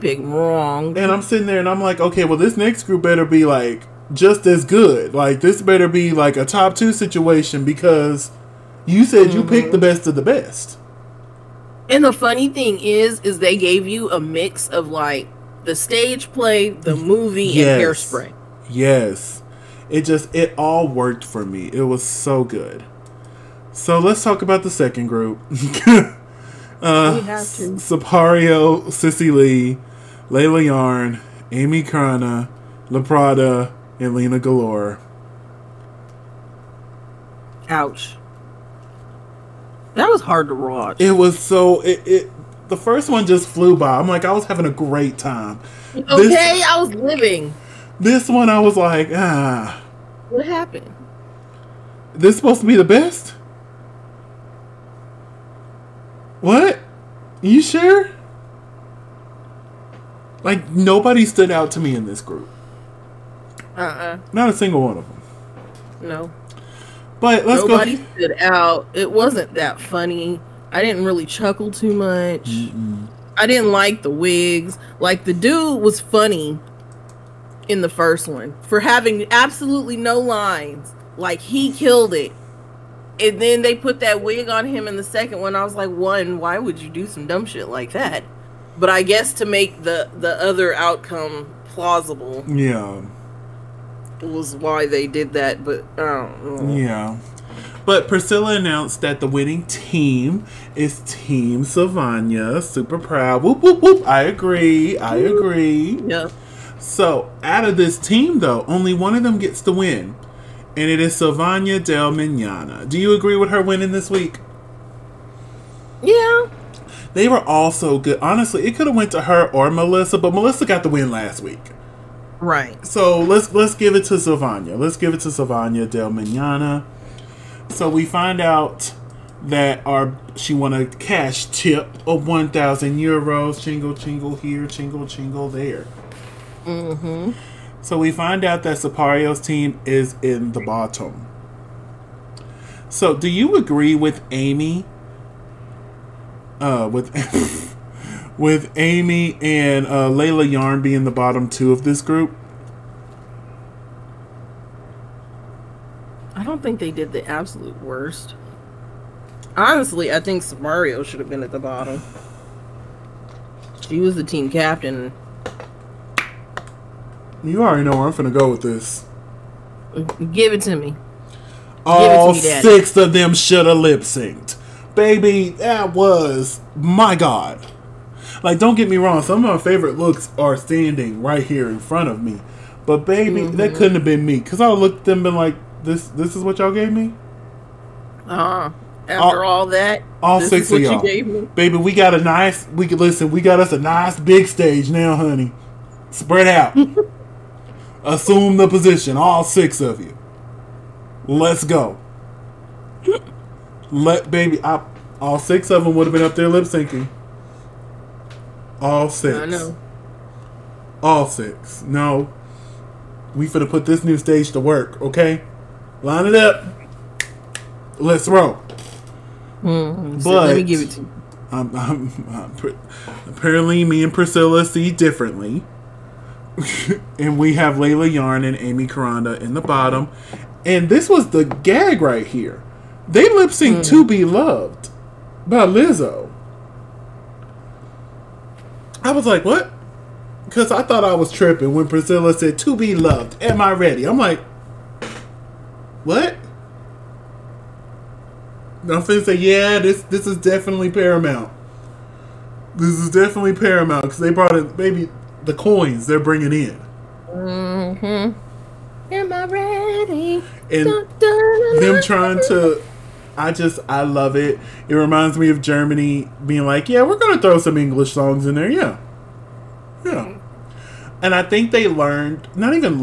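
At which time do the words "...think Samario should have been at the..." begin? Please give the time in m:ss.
2:40.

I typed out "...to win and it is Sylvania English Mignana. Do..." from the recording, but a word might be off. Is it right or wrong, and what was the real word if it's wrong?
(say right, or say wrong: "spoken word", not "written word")
wrong: "Del", not "English".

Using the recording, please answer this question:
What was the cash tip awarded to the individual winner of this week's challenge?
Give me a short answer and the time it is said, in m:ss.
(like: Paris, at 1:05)
1,000 euros, at 2:12.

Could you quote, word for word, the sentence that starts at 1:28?
But I guess to make the the other outcome plausible.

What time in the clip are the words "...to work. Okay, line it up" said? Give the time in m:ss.
3:34.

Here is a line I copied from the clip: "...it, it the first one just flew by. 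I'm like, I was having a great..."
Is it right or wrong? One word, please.
right.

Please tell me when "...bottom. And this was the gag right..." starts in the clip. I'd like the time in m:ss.
3:49.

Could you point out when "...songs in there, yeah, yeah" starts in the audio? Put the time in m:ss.
4:28.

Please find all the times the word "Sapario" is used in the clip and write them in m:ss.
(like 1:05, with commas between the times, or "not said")
0:27, 2:18.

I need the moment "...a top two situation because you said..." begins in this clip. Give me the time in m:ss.
0:06.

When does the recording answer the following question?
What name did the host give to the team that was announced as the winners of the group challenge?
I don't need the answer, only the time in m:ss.
1:41.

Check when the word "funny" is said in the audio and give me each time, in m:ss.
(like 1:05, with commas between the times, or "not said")
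0:12, 1:09, 1:16.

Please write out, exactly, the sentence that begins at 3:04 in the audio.
Cause I looked at them and like, this this is what y'all gave me?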